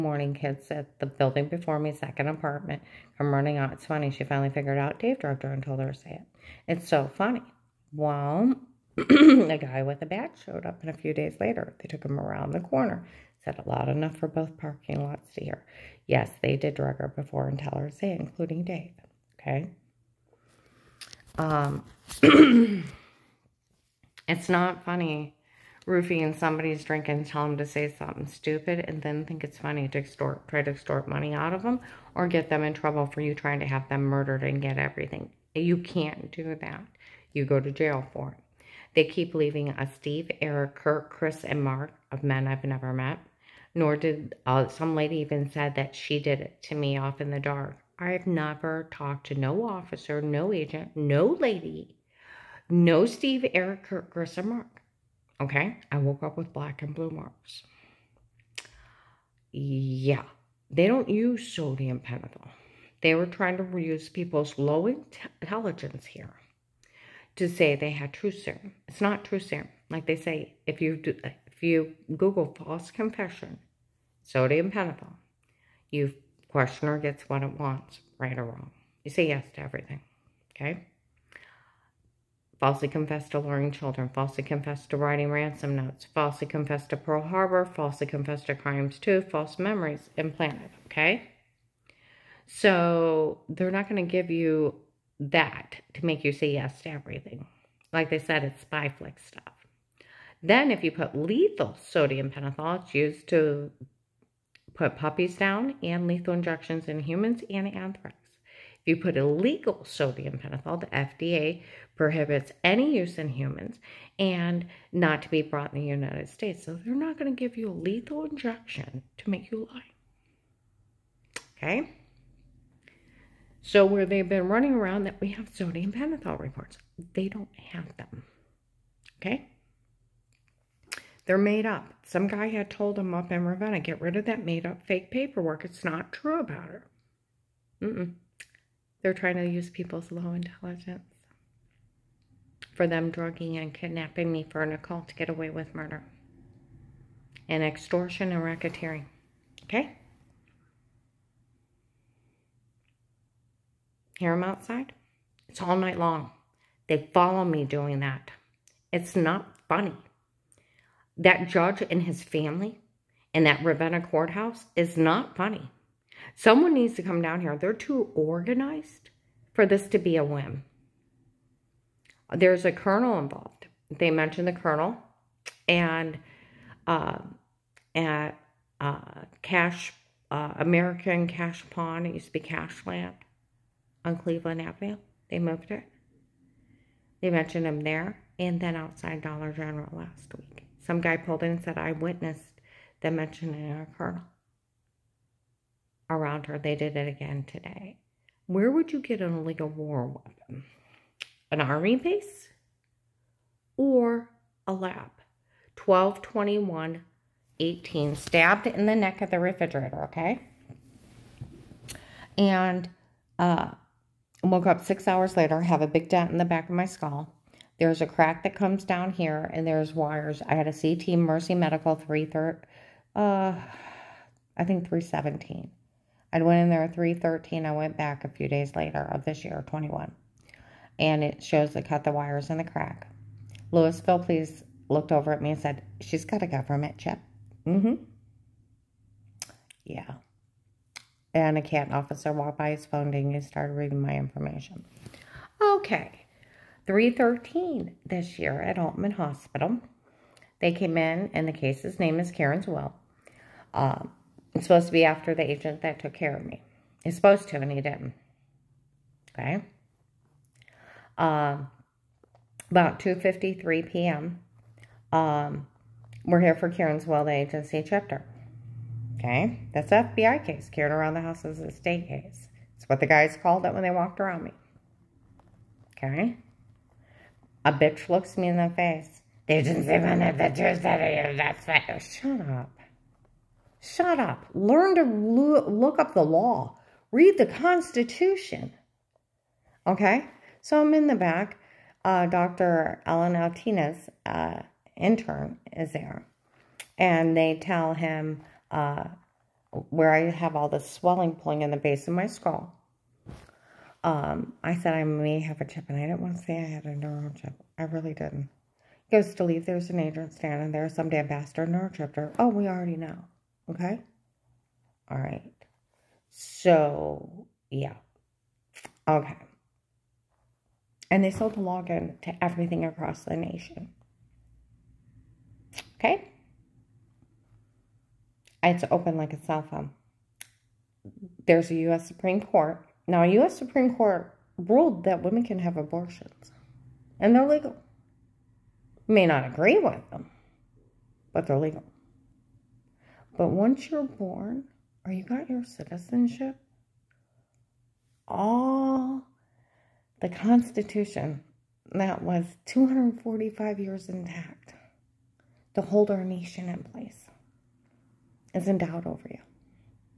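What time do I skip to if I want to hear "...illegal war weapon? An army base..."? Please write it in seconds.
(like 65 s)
199 s.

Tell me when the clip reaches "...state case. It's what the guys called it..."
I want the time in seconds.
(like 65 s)
271 s.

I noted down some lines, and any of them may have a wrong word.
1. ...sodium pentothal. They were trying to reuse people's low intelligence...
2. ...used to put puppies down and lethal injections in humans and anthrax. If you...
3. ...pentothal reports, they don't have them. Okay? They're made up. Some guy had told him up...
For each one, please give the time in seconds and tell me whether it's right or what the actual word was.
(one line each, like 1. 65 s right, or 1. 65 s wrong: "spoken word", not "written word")
1. 61 s right
2. 102 s right
3. 125 s right.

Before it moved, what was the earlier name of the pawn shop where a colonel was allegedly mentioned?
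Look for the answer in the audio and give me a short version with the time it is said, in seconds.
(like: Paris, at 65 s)
Cashland, at 182 s.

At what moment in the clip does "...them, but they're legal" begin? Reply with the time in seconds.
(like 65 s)
340 s.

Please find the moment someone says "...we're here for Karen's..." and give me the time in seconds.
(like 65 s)
266 s.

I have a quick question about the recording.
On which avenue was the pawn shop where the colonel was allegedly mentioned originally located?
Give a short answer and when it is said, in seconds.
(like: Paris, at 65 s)
Cleveland Avenue, at 184 s.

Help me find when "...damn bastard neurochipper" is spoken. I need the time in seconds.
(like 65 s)
311 s.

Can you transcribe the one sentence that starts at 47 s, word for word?
I have never talked to no officer, no agent, no lady, no Steve, Eric, Kirk, Chris, or Mark.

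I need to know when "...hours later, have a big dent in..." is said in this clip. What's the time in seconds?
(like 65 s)
215 s.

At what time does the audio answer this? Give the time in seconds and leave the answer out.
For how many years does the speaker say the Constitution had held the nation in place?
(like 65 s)
352 s.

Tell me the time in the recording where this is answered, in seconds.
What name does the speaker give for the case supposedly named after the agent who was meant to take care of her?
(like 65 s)
252 s.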